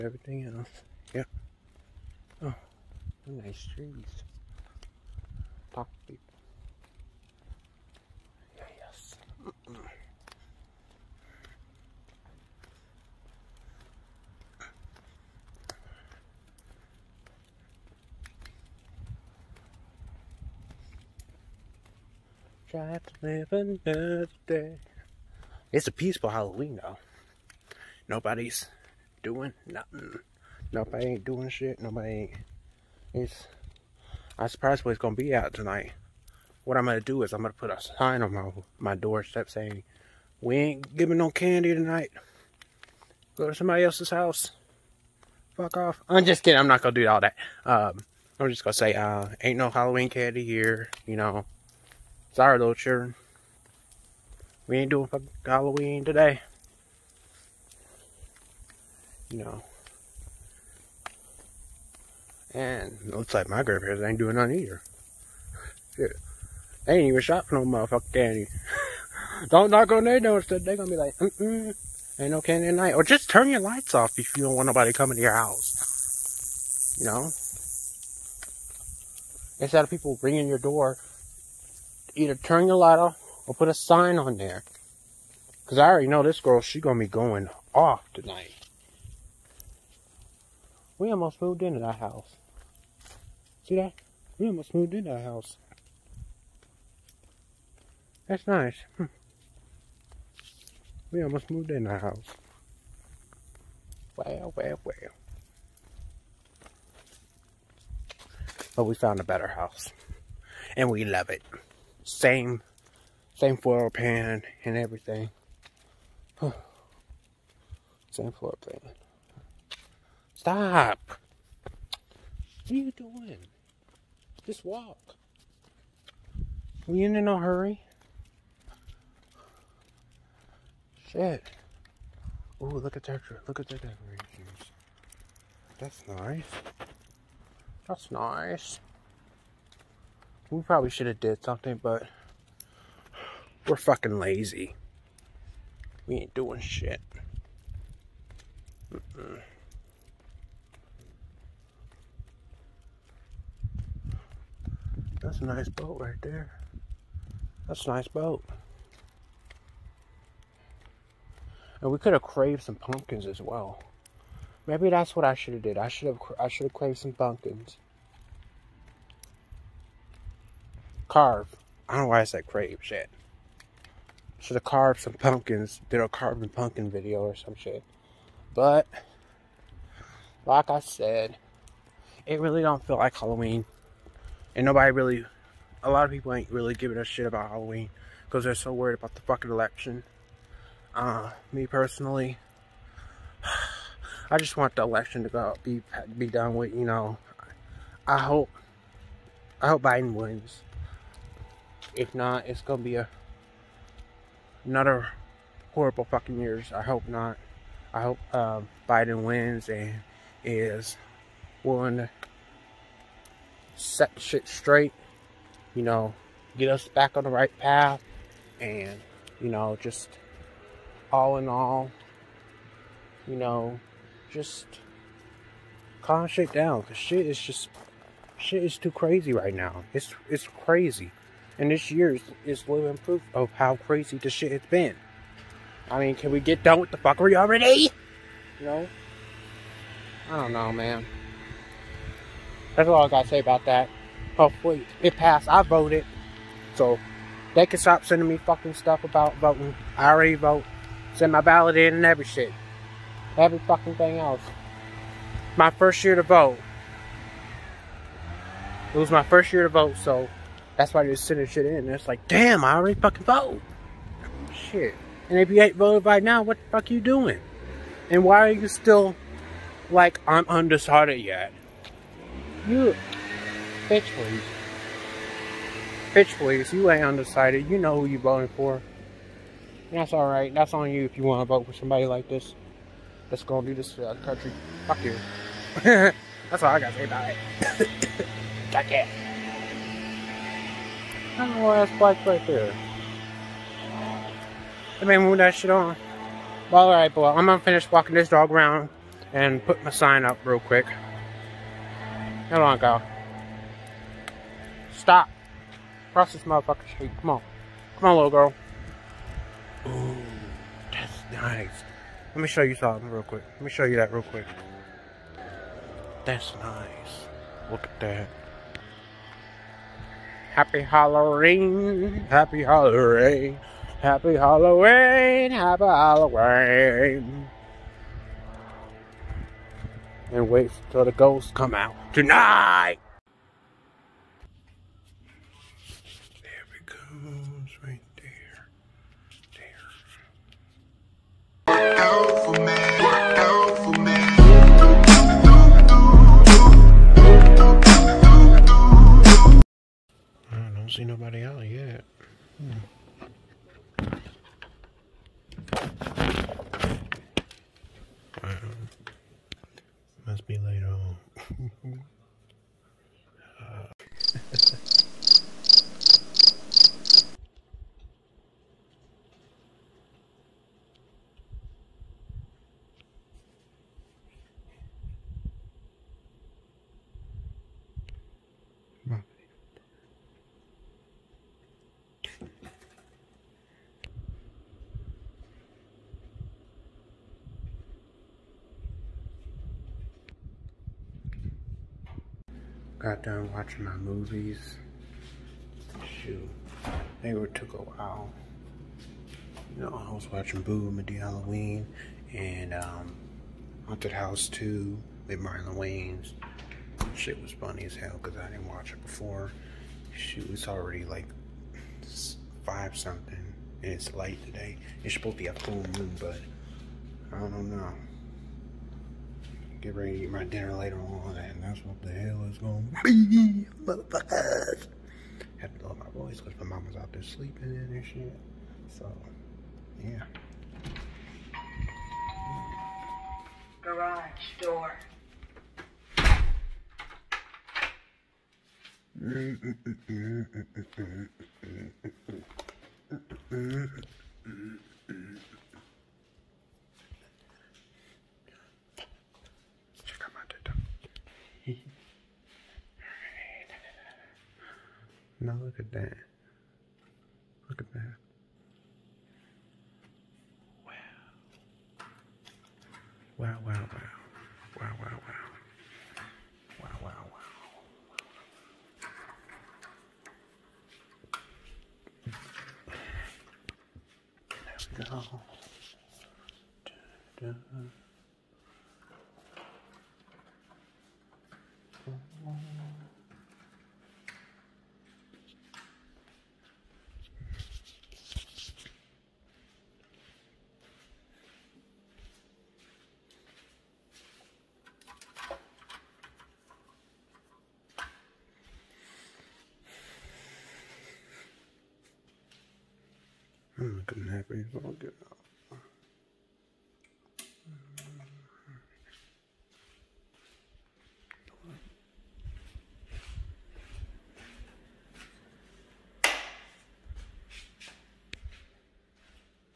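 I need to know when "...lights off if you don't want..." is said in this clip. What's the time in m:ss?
1:13.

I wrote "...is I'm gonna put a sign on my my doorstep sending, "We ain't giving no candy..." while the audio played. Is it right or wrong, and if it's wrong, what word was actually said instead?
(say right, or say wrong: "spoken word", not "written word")
wrong: "saying", not "sending".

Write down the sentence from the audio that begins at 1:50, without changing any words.
And we love it same same floor pan and everything.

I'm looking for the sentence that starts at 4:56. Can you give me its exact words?
Well, alright, boy, I'm gonna finish walking this dog around and put my sign up real quick.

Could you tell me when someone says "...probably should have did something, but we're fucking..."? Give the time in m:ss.
2:20.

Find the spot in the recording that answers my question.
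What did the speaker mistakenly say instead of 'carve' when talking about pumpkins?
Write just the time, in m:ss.
2:52.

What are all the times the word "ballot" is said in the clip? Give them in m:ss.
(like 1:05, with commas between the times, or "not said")
4:11.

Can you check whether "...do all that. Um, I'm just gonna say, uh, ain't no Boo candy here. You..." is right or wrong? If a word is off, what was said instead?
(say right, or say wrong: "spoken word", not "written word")
wrong: "Halloween", not "Boo".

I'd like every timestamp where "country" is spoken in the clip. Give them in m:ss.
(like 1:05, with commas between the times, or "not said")
4:44.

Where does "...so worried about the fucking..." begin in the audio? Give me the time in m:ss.
3:08.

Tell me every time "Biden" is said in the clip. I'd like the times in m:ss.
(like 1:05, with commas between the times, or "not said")
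3:19, 3:28.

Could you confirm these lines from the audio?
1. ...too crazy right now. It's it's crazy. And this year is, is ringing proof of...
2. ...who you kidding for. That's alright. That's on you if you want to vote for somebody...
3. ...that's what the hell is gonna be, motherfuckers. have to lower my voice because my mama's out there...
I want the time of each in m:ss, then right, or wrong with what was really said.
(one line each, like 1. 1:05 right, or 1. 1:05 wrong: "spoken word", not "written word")
1. 3:48 wrong: "living", not "ringing"
2. 4:37 wrong: "voting", not "kidding"
3. 7:01 right.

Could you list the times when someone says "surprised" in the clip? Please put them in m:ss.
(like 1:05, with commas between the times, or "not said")
0:34.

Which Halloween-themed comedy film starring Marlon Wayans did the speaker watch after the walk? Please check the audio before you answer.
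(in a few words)
Haunted House 2.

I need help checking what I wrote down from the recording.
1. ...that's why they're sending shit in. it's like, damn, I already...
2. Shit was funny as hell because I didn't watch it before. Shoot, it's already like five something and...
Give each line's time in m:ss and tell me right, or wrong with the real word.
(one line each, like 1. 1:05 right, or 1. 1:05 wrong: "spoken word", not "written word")
1. 4:20 right
2. 6:47 right.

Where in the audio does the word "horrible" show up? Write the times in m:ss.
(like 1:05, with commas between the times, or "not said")
3:25.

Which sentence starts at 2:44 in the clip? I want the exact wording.
Maybe that's what I should have did.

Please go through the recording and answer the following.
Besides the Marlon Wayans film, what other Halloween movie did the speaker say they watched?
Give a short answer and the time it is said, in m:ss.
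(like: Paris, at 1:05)
Boo the Halloween, at 6:40.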